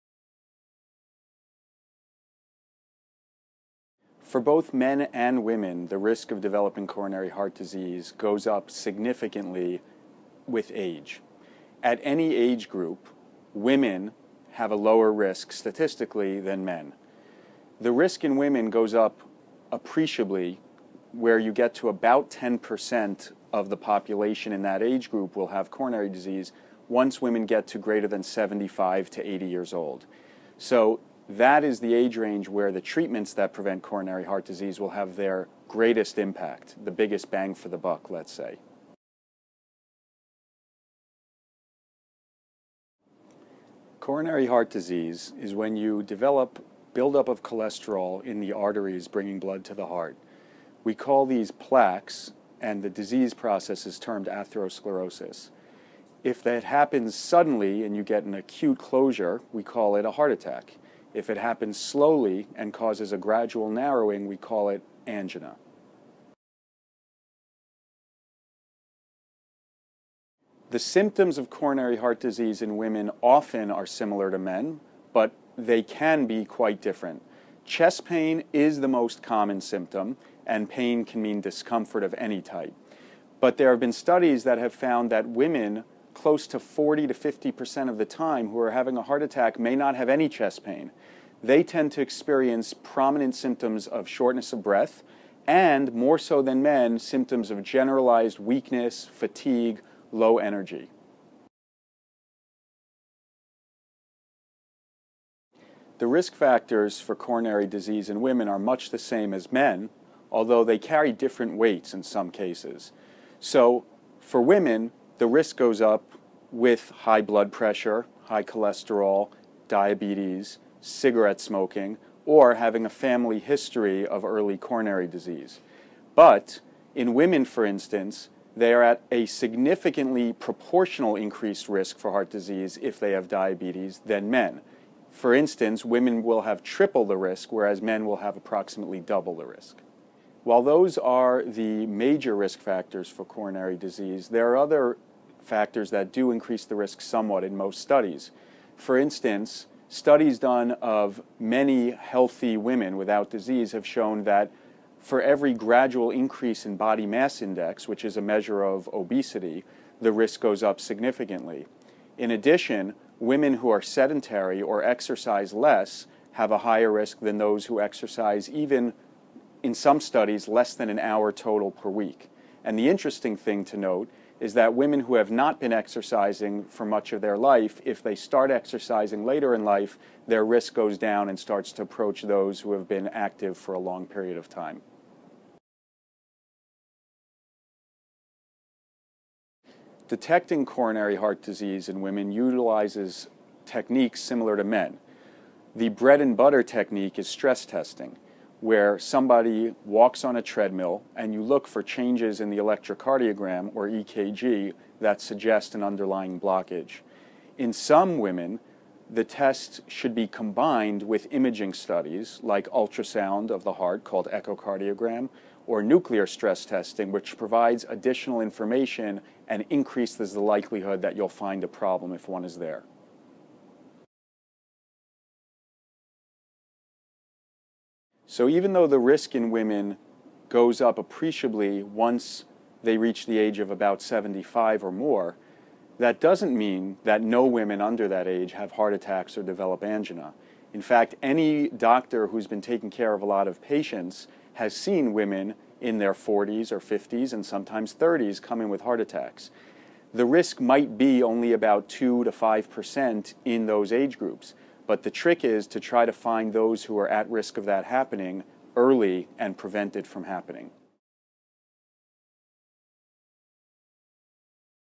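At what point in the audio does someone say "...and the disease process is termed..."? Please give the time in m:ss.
0:52.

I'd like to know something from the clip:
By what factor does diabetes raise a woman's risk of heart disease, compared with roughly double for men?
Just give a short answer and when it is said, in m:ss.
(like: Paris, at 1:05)
Triple, at 2:16.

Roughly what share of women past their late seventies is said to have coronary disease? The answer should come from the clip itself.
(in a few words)
10%.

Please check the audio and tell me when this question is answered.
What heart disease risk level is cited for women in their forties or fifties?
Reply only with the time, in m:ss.
4:11.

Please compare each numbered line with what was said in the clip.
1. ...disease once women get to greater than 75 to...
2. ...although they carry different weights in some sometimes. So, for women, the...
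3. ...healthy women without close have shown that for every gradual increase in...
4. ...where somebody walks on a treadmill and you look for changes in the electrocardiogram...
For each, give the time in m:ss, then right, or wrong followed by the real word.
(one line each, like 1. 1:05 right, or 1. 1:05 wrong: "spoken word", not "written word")
1. 0:26 right
2. 1:50 wrong: "cases", not "sometimes"
3. 2:31 wrong: "disease", not "close"
4. 3:18 right.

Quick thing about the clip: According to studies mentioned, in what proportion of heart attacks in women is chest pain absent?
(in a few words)
40 to 50%.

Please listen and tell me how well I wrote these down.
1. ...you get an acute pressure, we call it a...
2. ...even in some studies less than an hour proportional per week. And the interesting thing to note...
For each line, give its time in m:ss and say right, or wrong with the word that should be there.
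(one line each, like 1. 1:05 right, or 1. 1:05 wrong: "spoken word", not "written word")
1. 0:57 wrong: "closure", not "pressure"
2. 2:48 wrong: "total", not "proportional".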